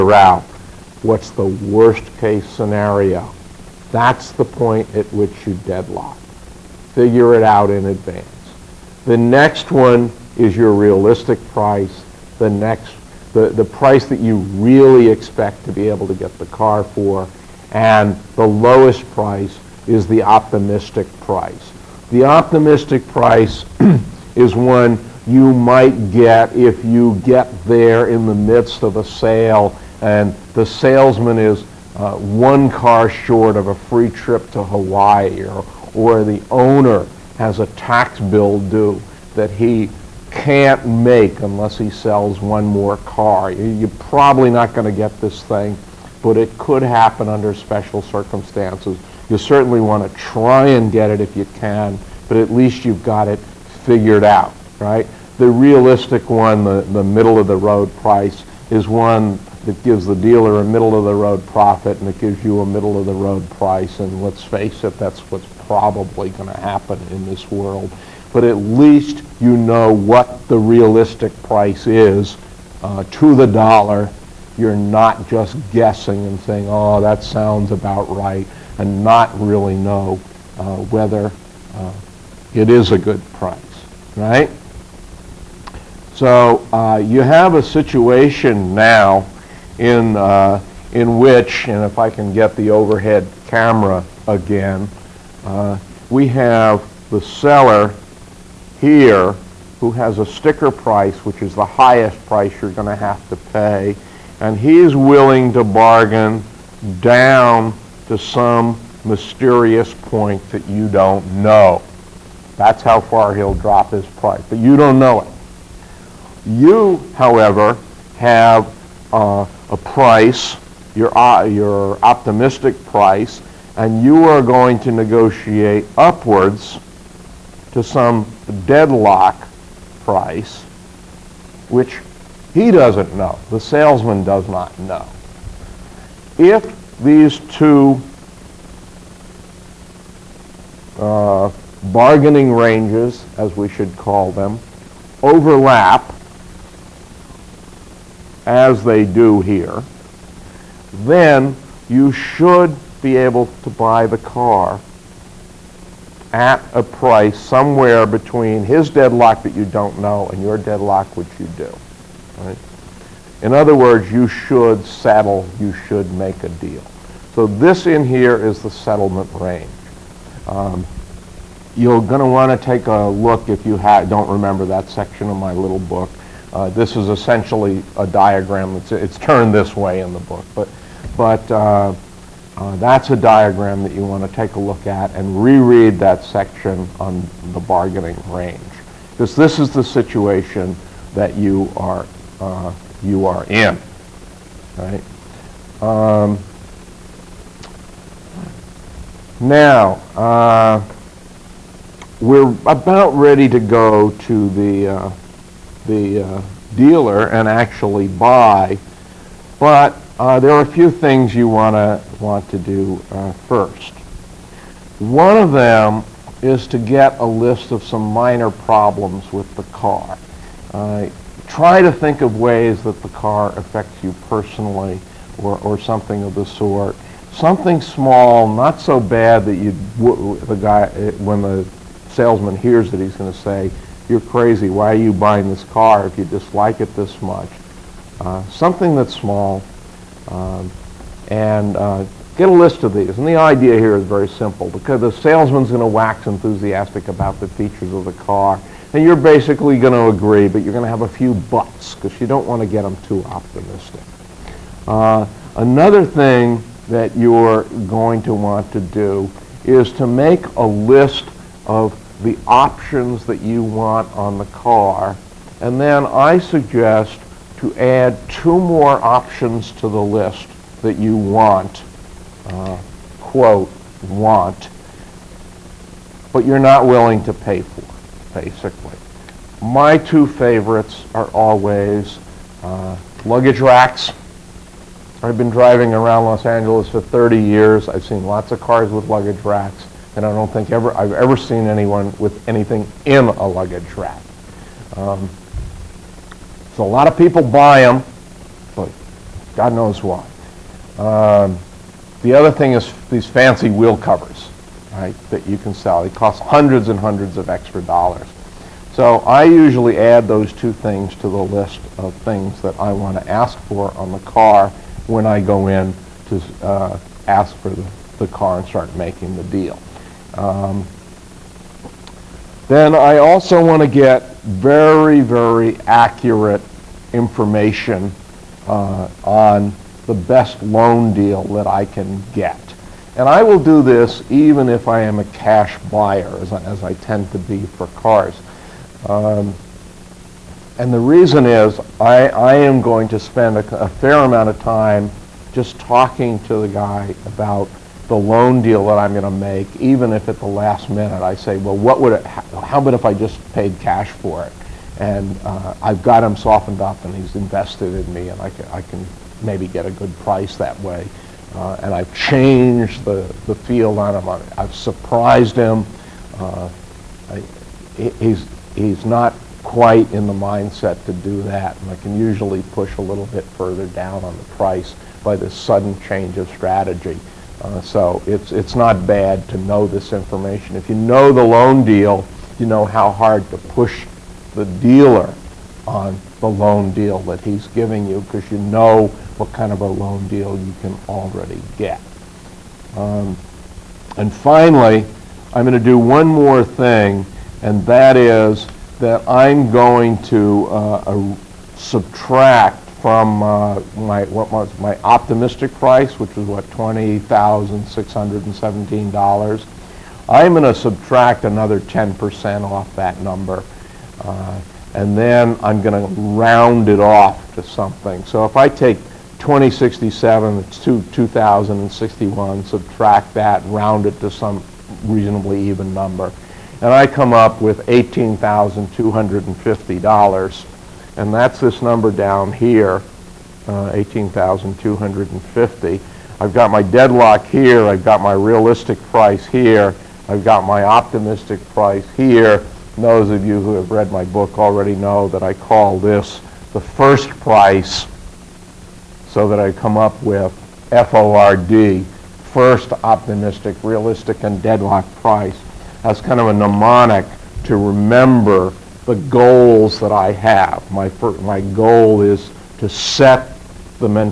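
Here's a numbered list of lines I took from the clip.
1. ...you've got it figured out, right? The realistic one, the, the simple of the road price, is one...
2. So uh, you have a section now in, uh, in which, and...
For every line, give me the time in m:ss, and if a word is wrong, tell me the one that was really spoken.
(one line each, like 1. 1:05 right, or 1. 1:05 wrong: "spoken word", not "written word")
1. 0:52 wrong: "middle", not "simple"
2. 1:26 wrong: "situation", not "section".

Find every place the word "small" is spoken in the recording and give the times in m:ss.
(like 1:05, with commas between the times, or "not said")
3:47, 3:59.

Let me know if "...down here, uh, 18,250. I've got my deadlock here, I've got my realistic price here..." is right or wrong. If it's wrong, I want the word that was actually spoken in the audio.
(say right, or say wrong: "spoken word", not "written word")
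right.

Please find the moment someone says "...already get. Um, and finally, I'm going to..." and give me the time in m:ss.
6:31.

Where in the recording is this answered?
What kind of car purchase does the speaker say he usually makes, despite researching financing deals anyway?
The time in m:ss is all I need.
5:35.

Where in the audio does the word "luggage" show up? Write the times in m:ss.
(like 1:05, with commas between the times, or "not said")
4:43, 4:49, 4:53.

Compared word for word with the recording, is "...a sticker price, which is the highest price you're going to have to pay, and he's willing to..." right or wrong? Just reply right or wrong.
right.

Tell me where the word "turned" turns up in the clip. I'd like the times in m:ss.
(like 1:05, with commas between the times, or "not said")
2:59.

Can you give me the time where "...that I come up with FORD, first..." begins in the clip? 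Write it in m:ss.
7:29.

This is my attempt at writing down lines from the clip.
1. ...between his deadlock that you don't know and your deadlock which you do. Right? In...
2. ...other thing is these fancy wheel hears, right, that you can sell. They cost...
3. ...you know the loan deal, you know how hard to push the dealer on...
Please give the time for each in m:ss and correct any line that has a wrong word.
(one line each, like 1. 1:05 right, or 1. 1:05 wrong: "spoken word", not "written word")
1. 2:38 right
2. 5:02 wrong: "covers", not "hears"
3. 6:20 right.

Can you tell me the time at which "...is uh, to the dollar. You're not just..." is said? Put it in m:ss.
1:11.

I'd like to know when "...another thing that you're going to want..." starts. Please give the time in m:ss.
4:15.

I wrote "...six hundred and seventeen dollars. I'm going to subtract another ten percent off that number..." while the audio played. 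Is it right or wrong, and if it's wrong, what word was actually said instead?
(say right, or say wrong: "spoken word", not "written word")
right.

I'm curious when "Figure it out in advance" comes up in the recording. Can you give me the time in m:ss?
0:06.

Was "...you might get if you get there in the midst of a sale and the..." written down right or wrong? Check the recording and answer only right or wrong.
right.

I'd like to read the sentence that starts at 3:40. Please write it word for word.
Uh, try to think of ways that the car affects you personally or, or something of the sort.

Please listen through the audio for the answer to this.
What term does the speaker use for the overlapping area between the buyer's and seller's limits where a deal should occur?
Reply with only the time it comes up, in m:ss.
2:48.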